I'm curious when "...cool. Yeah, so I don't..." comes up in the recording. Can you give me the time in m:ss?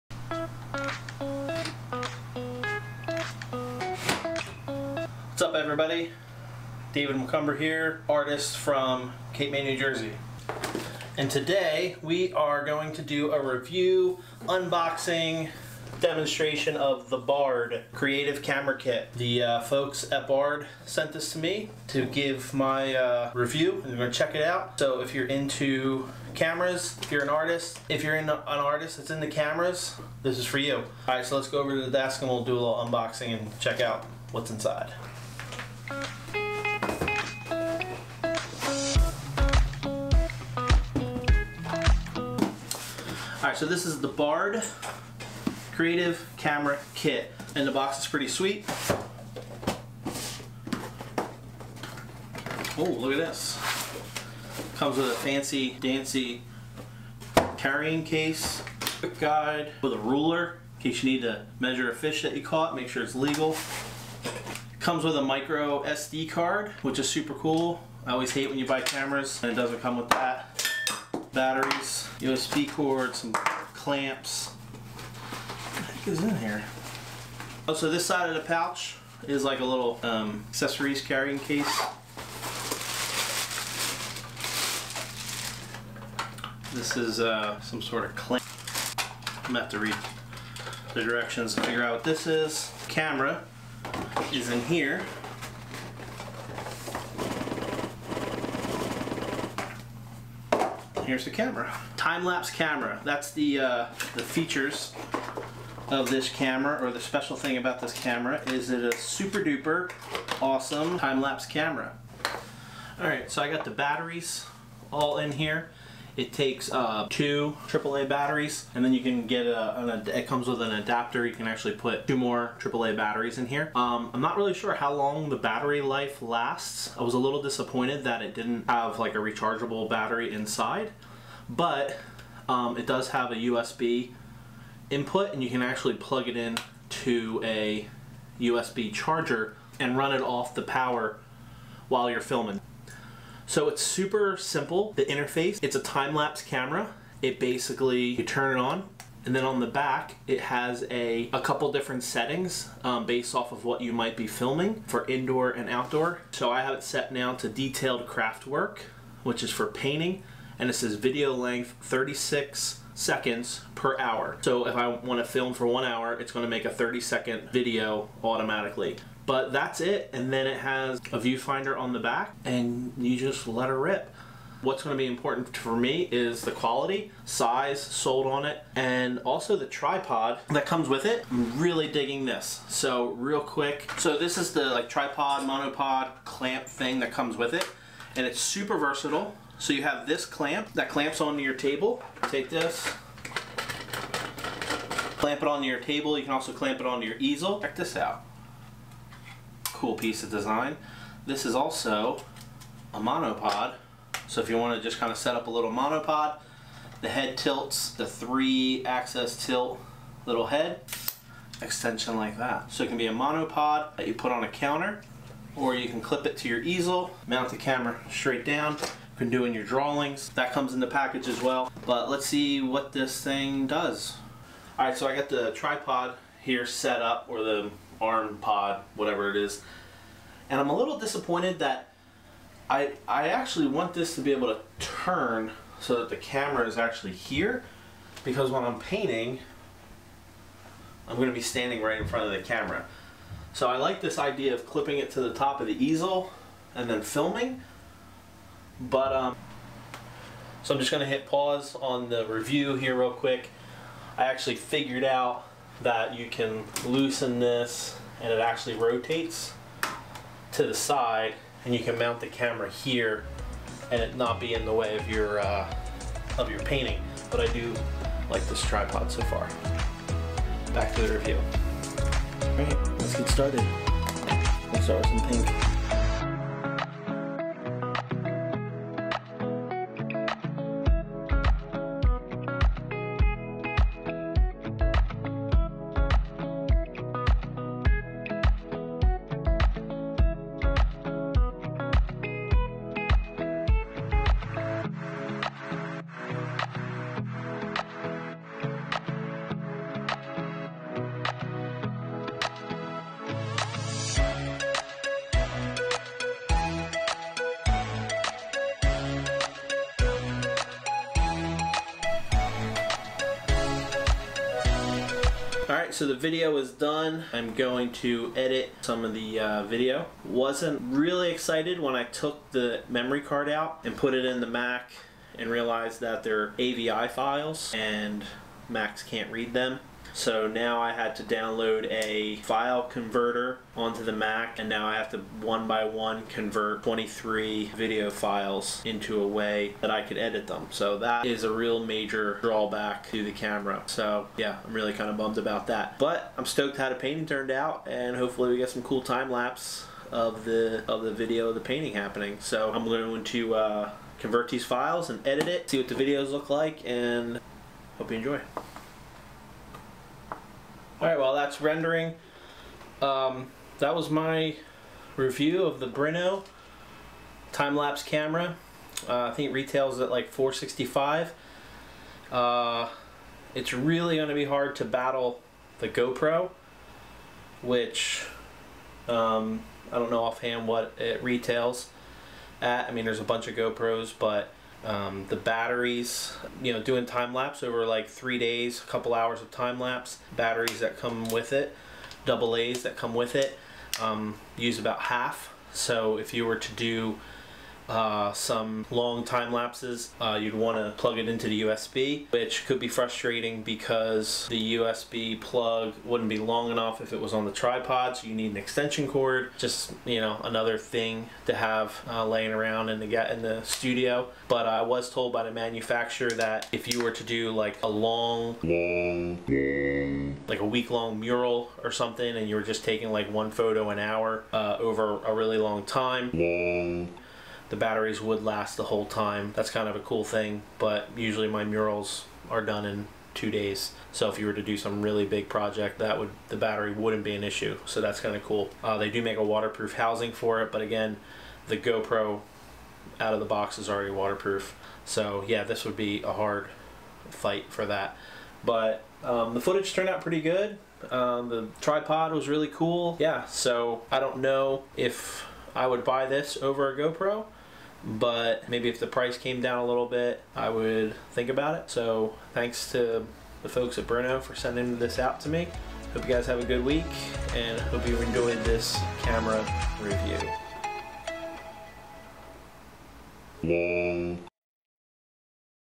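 7:32.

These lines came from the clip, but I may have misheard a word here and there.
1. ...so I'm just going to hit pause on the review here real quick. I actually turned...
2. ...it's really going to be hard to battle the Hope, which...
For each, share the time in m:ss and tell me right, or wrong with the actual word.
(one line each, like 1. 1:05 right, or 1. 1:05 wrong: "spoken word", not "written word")
1. 4:10 wrong: "figured", not "turned"
2. 6:13 wrong: "GoPro", not "Hope".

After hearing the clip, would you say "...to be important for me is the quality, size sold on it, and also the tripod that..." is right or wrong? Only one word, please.
right.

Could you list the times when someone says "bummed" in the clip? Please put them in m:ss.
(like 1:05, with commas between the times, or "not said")
5:45.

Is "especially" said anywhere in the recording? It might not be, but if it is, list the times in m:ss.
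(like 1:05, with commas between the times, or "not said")
not said.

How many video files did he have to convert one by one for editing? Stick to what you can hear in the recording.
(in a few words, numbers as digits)
23.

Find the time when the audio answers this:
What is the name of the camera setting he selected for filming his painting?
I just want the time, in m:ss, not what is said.
2:37.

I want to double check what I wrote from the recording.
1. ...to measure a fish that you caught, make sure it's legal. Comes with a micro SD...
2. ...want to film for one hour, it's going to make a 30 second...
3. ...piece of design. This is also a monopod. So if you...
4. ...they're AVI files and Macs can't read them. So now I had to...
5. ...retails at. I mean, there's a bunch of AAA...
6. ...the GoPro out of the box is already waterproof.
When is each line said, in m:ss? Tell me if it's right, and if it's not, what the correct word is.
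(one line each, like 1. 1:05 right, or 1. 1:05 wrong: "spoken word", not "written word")
1. 1:01 right
2. 2:44 right
3. 3:19 right
4. 5:26 right
5. 6:21 wrong: "GoPros", not "AAA"
6. 7:21 right.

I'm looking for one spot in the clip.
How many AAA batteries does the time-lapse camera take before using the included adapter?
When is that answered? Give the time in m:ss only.
1:57.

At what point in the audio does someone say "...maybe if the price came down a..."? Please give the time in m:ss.
7:38.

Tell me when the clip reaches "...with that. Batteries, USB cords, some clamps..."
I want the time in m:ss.
1:09.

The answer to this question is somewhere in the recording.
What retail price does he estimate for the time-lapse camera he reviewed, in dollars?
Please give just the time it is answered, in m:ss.
6:10.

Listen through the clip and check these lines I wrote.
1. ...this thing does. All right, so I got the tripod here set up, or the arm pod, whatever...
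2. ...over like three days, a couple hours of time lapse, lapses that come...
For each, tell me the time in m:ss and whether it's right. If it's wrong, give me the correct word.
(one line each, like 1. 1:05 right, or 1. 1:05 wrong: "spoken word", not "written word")
1. 3:42 right
2. 6:27 wrong: "batteries", not "lapses".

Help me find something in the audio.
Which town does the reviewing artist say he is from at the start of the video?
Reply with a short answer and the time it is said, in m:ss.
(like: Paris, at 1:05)
Cape May, New Jersey, at 0:09.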